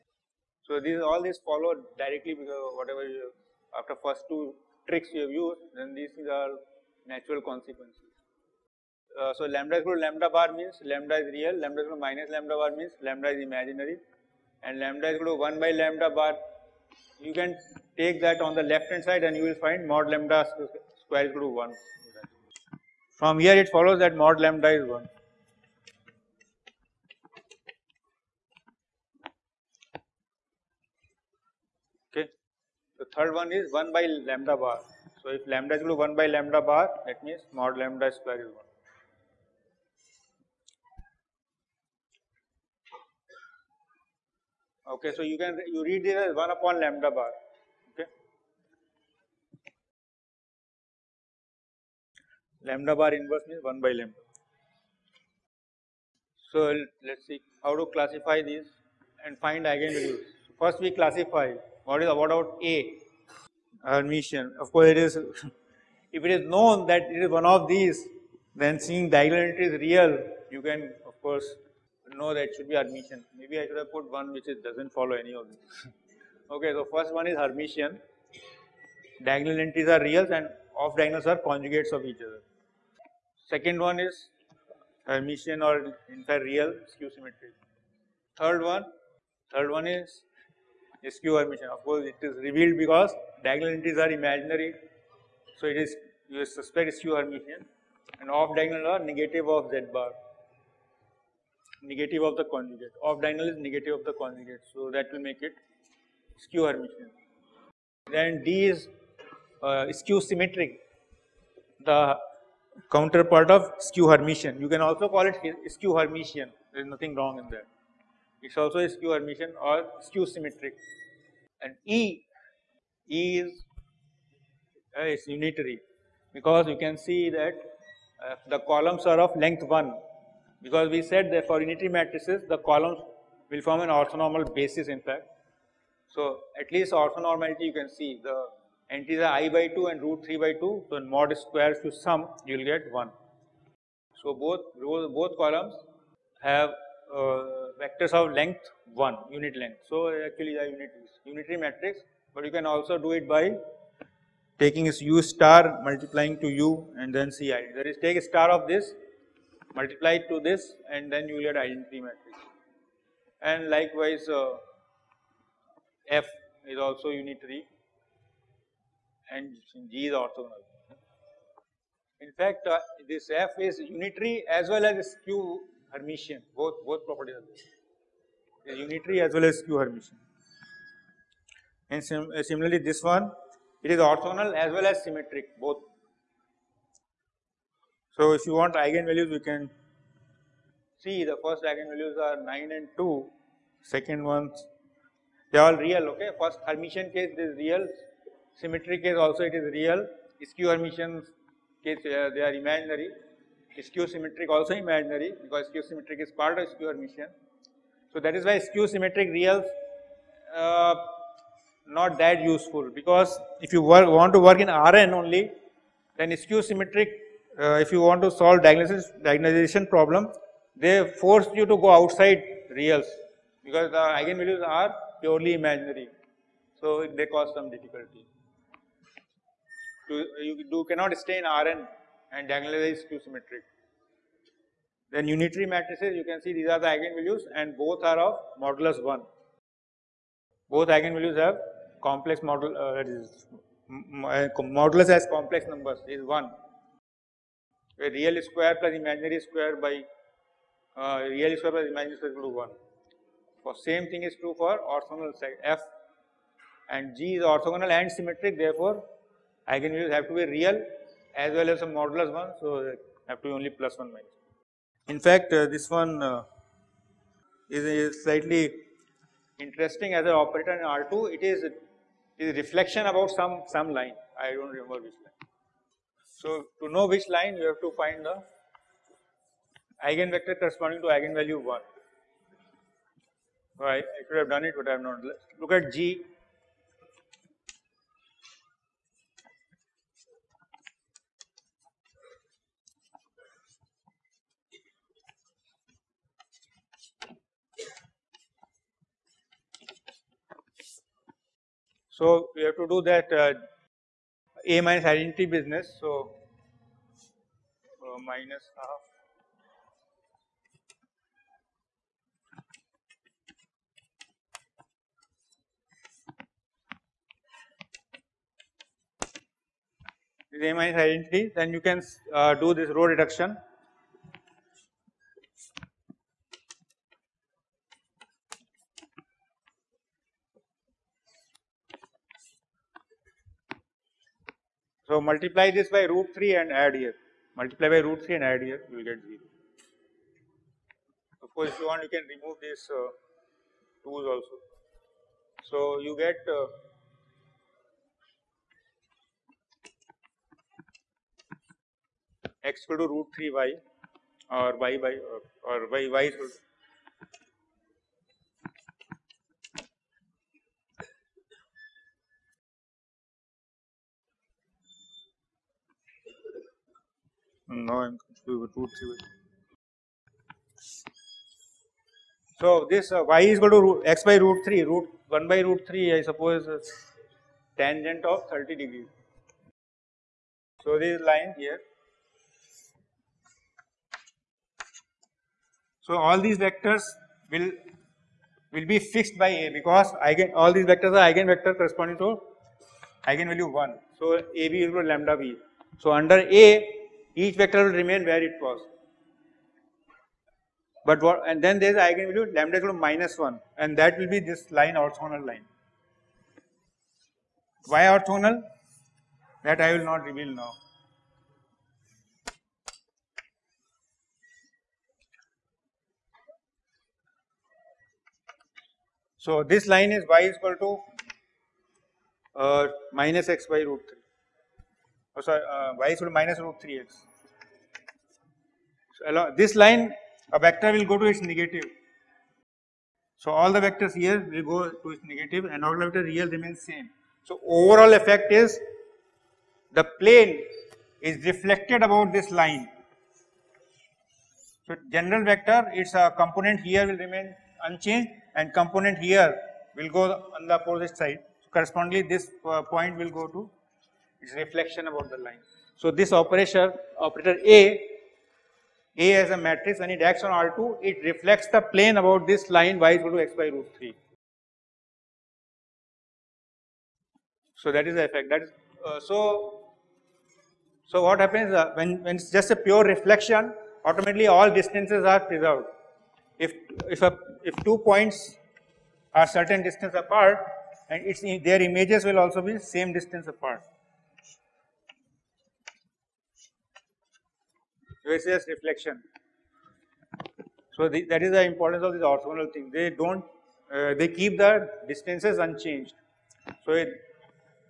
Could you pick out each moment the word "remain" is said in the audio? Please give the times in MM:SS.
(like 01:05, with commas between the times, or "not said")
06:37, 07:16, 07:27.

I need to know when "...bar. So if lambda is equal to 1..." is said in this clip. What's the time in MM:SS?
00:34.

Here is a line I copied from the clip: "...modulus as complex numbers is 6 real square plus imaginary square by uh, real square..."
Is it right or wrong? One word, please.
wrong.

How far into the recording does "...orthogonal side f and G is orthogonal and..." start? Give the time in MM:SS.
04:14.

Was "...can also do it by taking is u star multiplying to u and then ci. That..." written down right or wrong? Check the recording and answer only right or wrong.
right.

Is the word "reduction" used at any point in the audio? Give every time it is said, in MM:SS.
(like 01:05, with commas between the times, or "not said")
05:23.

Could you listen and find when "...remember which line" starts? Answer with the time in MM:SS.
04:34.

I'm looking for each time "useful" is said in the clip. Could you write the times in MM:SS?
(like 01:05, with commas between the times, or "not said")
03:32.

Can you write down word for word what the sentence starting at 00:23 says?
From here it follows that mod lambda is 1.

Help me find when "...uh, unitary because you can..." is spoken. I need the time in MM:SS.
02:04.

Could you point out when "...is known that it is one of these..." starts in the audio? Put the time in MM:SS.
01:06.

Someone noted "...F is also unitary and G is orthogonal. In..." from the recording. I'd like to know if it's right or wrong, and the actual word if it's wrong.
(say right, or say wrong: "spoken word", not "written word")
right.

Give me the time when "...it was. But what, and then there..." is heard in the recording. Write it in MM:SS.
06:38.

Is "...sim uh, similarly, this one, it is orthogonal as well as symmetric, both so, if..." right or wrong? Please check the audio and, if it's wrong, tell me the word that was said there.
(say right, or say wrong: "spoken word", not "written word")
right.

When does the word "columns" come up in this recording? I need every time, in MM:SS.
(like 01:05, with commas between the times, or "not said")
02:08, 02:12, 02:25.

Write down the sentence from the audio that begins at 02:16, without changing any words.
So, at least orthonormality you can see the entries are i by 2 and root 3 by 2.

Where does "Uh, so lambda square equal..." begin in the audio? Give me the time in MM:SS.
00:09.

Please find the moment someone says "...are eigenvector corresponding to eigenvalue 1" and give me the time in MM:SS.
06:31.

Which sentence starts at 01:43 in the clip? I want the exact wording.
Off diagonal is negative of the conjugate.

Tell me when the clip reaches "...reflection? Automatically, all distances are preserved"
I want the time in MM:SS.
07:53.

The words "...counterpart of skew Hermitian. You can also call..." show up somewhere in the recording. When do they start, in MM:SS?
01:52.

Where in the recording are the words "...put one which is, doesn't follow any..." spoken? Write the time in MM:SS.
01:13.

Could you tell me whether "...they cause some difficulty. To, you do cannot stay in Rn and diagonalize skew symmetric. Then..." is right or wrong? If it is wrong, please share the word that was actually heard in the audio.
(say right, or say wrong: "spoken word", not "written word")
right.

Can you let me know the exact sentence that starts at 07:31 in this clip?
So, correspondingly this uh, point will go to it's reflection about the line.